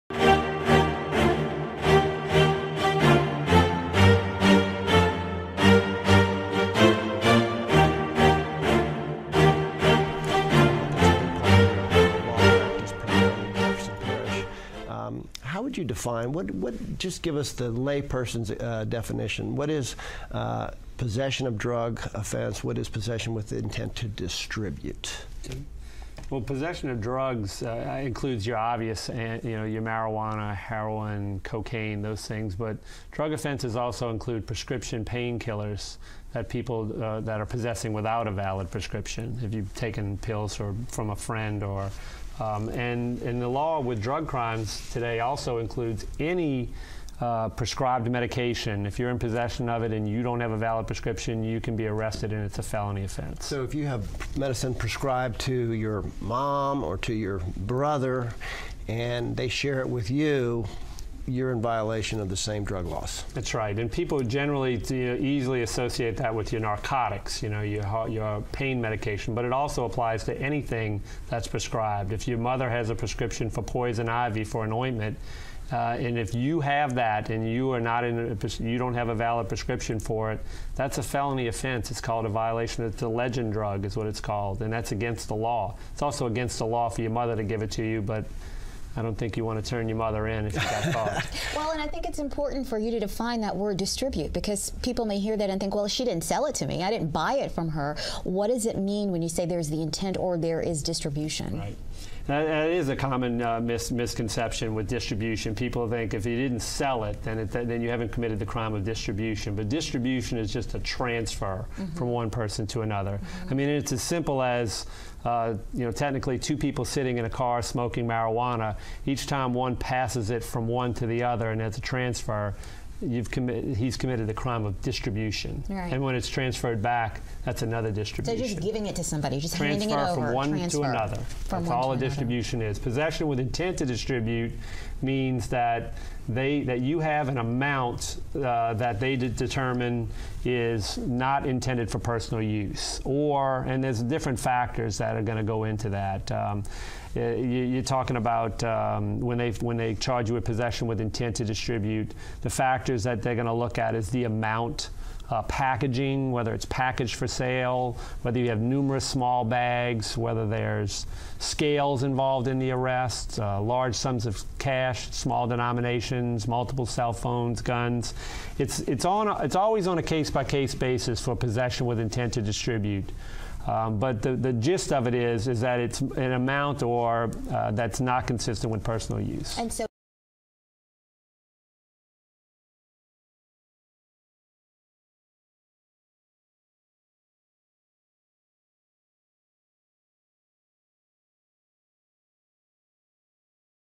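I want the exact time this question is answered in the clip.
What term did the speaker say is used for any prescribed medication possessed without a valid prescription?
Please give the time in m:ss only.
1:23.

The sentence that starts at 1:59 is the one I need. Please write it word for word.
Each time one passes it from one to the other, and it's a transfer you've committed he's committed the crime of distribution.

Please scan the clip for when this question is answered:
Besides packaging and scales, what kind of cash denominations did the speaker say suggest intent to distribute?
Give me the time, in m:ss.
2:45.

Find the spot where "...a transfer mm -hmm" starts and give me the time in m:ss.
1:50.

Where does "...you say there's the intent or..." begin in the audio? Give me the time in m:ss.
1:39.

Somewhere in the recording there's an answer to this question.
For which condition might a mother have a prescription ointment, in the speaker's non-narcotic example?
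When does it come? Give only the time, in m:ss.
1:13.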